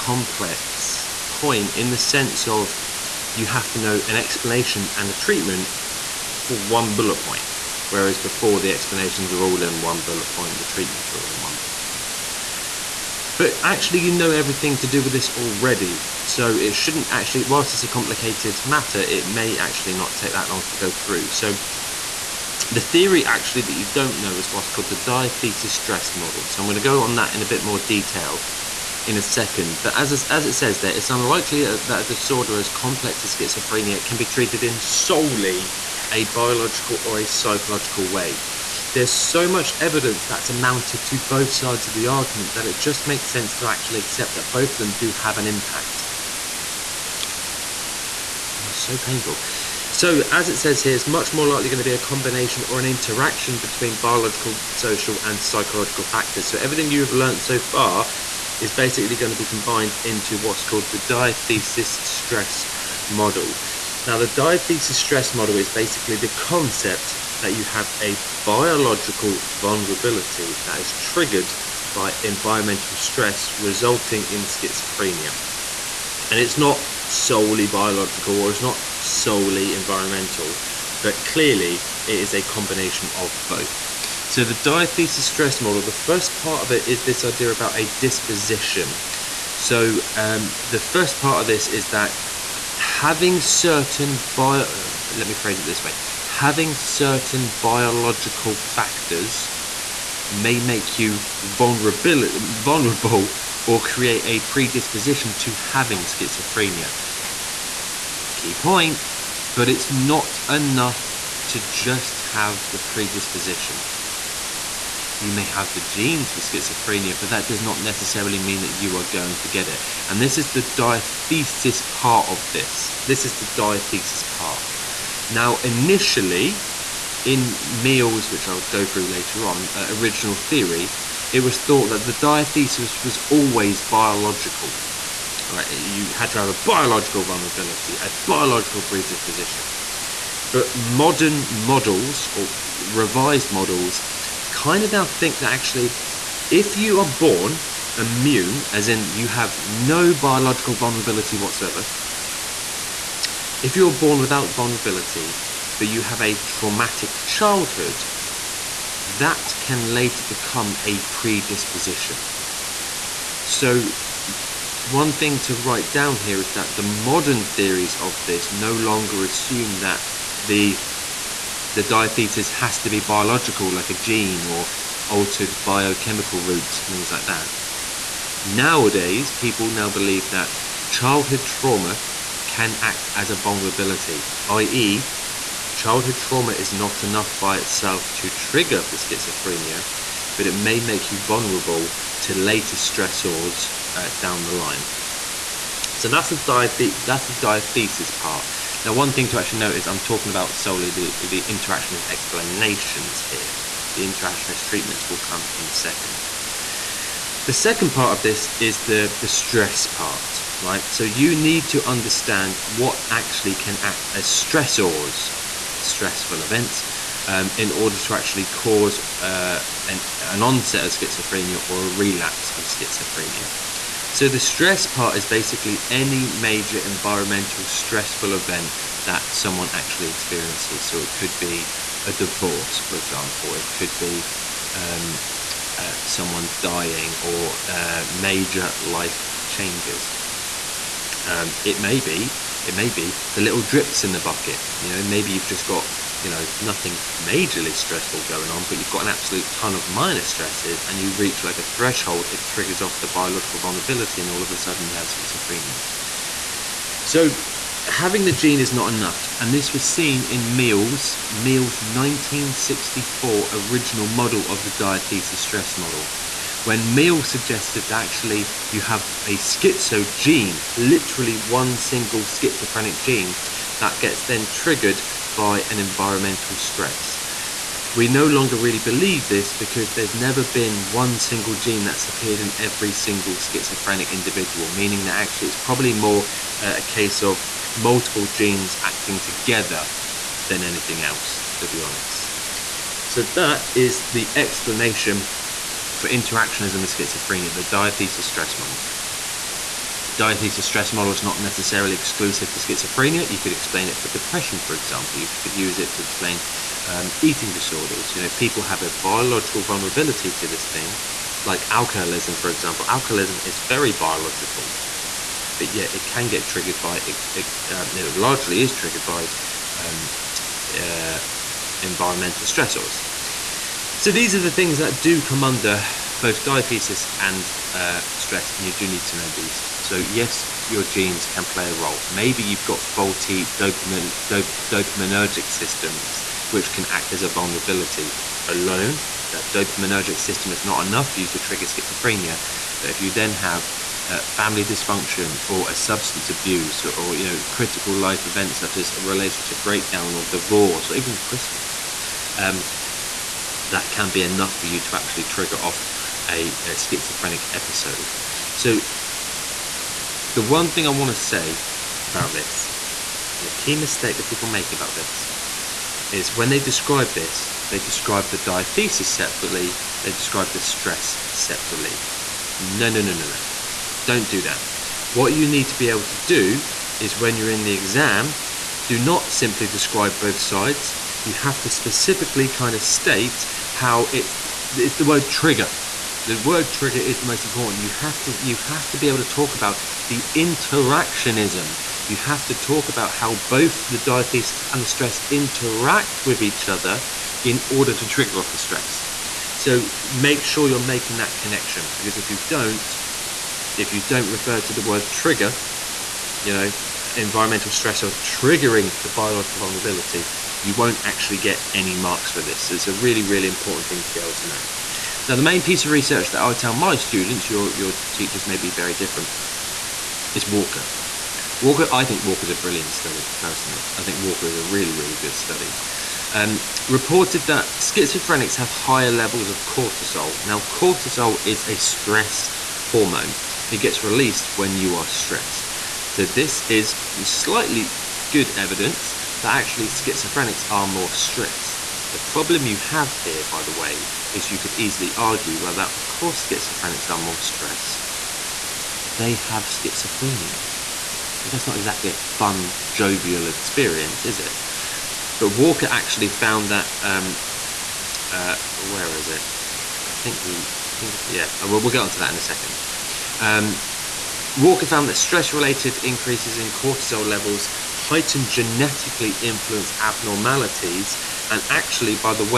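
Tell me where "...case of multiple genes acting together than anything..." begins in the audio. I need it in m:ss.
4:46.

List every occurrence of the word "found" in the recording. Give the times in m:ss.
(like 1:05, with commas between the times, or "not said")
7:36, 7:44.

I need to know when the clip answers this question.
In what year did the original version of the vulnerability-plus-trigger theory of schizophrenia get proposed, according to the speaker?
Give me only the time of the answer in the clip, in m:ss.
4:21.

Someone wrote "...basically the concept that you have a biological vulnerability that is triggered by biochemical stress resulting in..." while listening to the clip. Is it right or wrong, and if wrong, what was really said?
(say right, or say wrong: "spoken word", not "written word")
wrong: "environmental", not "biochemical".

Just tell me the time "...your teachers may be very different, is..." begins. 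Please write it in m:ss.
6:57.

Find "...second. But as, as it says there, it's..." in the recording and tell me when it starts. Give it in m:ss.
0:29.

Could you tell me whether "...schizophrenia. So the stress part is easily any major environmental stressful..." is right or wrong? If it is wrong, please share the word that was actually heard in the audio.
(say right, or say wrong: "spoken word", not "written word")
wrong: "basically", not "easily".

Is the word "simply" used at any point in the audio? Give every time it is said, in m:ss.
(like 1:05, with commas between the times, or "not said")
6:19.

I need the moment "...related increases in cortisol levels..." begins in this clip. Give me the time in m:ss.
7:45.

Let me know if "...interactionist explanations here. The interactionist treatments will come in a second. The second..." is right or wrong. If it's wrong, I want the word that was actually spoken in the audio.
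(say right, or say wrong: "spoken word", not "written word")
right.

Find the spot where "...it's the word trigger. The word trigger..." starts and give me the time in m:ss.
6:24.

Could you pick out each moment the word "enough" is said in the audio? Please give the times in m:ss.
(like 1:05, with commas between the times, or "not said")
1:50, 3:07, 4:18, 5:40, 5:54.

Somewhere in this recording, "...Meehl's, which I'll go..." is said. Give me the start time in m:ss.
2:07.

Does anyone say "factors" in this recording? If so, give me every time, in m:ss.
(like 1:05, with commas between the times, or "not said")
0:56, 1:38.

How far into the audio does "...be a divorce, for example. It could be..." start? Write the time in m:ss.
3:51.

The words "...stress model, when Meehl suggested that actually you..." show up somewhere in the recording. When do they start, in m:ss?
4:25.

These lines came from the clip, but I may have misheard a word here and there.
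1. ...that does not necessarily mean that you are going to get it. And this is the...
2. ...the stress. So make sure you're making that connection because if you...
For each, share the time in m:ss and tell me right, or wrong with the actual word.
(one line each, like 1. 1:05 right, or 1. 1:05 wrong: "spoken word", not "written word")
1. 1:57 right
2. 6:38 right.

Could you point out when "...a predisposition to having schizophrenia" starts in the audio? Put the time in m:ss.
1:44.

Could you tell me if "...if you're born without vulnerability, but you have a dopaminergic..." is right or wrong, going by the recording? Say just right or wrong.
wrong.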